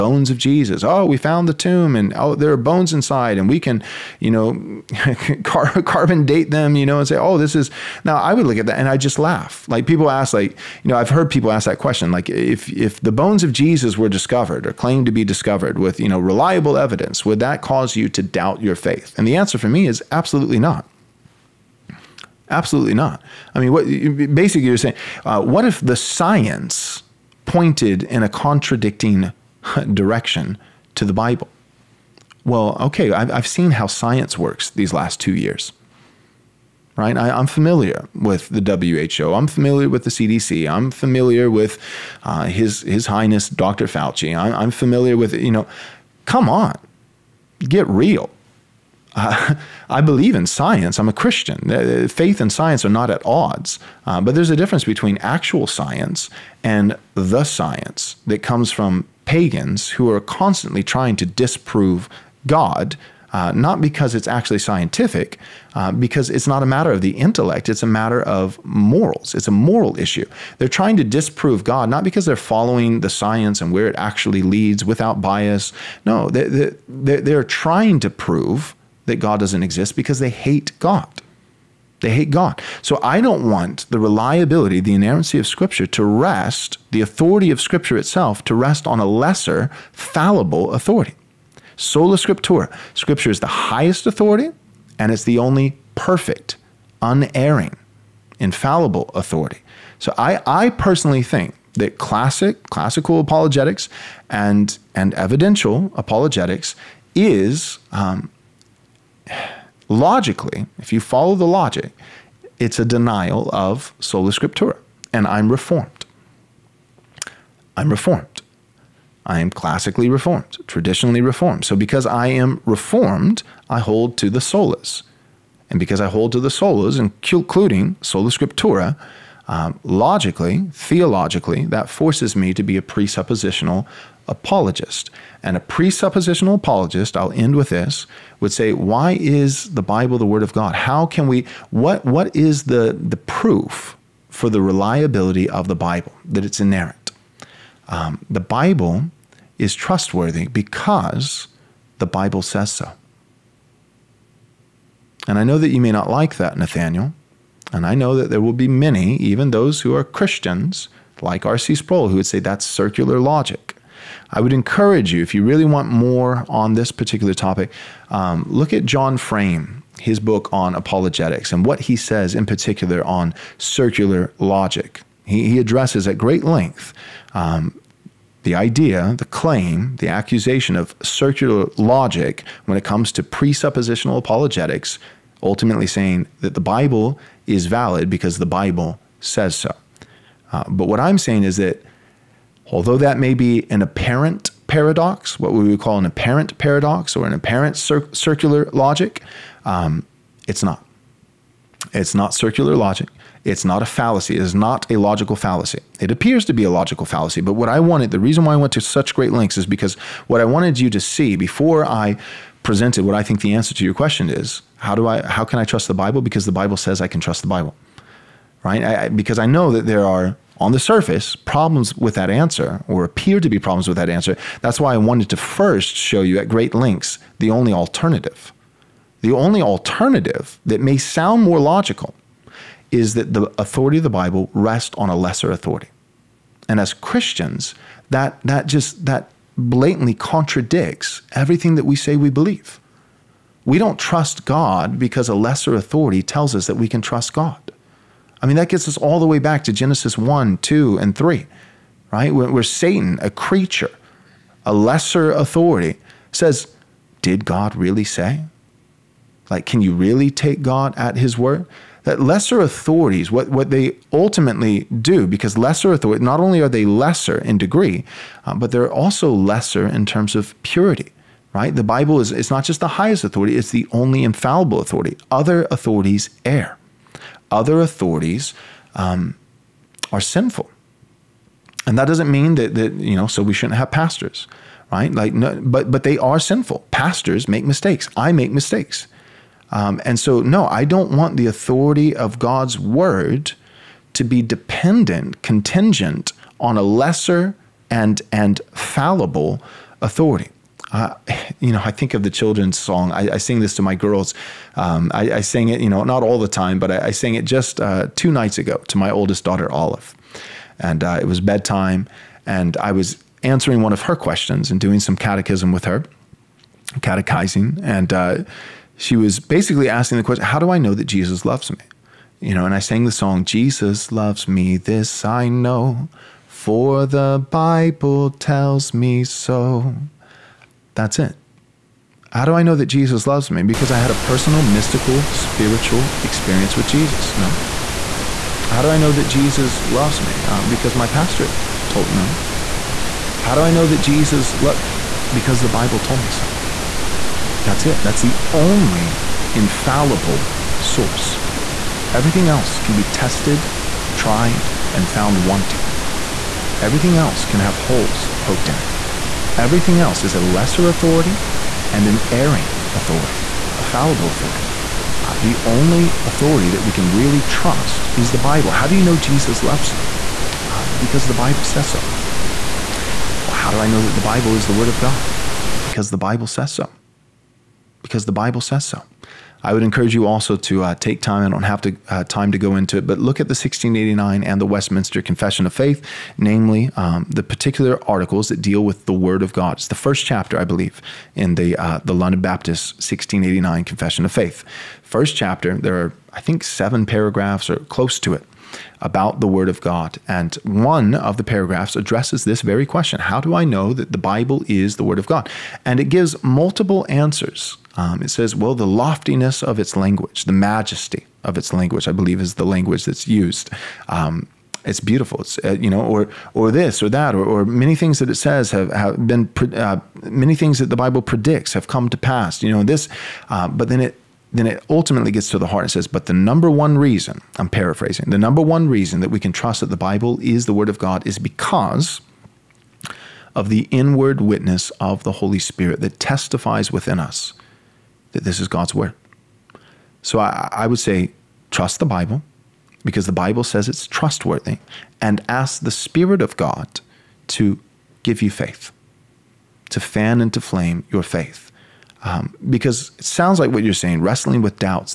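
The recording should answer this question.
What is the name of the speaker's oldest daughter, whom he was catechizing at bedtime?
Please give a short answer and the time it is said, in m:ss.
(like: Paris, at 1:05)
Olive, at 5:09.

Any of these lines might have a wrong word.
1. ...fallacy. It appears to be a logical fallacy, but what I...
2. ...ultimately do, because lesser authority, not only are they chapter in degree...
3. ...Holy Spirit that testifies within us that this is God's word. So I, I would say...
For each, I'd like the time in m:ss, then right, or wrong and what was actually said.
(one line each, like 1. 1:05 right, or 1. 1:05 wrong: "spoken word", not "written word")
1. 3:25 right
2. 4:24 wrong: "lesser", not "chapter"
3. 7:15 right.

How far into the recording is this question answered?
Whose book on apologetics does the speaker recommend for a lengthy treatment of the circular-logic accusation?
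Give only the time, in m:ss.
2:48.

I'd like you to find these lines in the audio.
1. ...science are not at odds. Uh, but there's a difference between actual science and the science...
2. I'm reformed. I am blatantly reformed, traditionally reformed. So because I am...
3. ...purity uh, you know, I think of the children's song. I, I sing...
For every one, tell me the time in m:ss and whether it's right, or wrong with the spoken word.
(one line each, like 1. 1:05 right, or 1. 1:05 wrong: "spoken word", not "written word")
1. 0:52 right
2. 1:57 wrong: "classically", not "blatantly"
3. 5:00 wrong: "authority", not "purity".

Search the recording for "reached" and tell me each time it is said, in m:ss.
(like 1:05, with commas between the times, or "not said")
not said.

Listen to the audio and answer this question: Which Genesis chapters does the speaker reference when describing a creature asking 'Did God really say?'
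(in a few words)
Genesis 1, 2, and 3.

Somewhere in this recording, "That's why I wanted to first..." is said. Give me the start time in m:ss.
3:44.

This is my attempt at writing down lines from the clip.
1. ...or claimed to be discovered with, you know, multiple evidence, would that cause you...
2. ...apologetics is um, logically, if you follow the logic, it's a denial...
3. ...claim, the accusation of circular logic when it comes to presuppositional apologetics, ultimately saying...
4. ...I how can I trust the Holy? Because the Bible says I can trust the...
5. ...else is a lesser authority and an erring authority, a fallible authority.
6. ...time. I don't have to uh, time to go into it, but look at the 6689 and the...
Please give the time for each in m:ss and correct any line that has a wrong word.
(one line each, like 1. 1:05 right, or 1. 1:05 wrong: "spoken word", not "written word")
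1. 0:14 wrong: "reliable", not "multiple"
2. 1:45 right
3. 2:59 right
4. 3:35 wrong: "Bible", not "Holy"
5. 5:59 right
6. 6:21 wrong: "1689", not "6689".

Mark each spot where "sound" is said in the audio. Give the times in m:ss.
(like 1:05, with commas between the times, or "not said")
3:50, 7:33.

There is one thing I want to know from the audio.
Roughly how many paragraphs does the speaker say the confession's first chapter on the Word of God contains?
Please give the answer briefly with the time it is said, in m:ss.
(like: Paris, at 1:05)
7, at 6:36.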